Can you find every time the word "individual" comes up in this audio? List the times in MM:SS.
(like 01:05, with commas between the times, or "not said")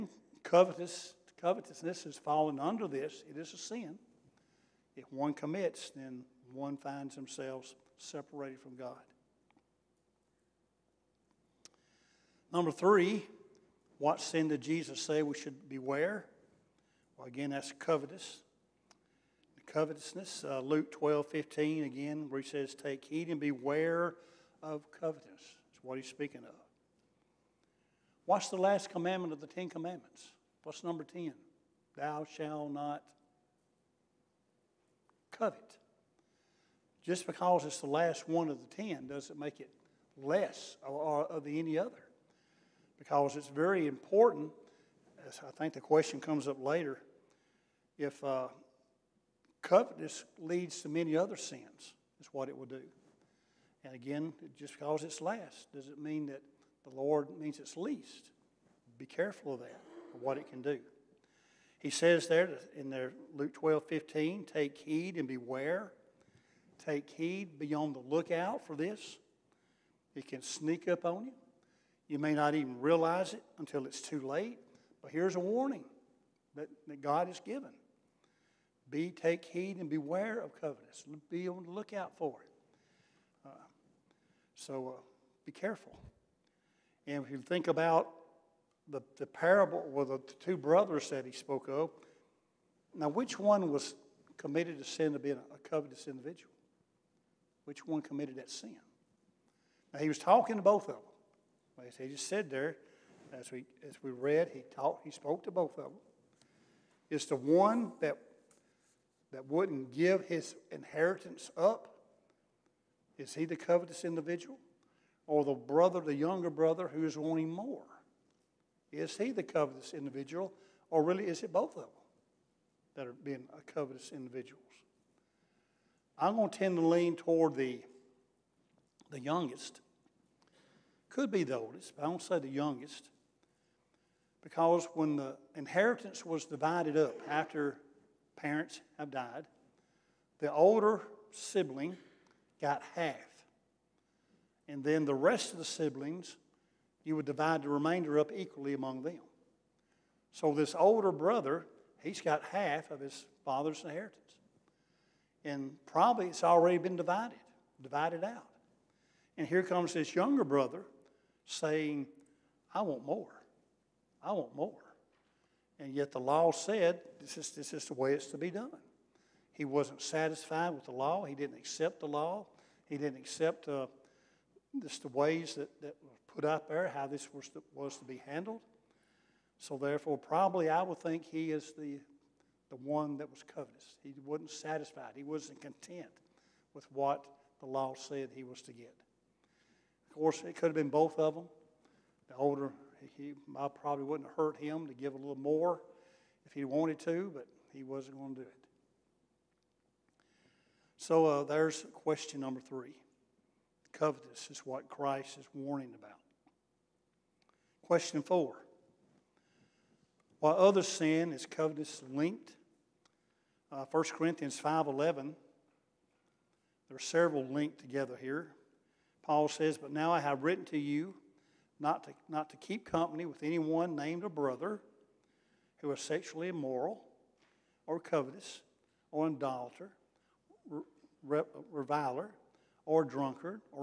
01:36, 01:54, 01:59, 02:04.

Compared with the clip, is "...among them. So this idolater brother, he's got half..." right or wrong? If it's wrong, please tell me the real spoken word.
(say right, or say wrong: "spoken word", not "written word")
wrong: "older", not "idolater".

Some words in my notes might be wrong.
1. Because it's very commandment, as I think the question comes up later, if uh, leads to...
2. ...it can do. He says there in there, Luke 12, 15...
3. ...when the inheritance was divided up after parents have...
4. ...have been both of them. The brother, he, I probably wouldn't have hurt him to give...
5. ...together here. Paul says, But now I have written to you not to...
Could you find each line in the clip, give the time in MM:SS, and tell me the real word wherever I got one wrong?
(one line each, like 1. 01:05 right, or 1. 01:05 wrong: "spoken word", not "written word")
1. 00:42 wrong: "important", not "commandment"
2. 01:00 right
3. 02:14 right
4. 03:10 wrong: "older", not "brother"
5. 03:37 right.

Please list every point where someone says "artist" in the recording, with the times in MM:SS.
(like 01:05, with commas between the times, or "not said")
not said.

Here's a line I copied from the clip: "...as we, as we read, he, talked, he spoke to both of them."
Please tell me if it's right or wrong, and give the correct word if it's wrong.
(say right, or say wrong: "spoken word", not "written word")
right.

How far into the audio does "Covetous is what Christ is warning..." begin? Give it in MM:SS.
03:23.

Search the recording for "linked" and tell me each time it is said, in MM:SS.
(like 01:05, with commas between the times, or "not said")
03:32, 03:37.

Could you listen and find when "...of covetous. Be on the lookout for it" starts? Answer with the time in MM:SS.
01:20.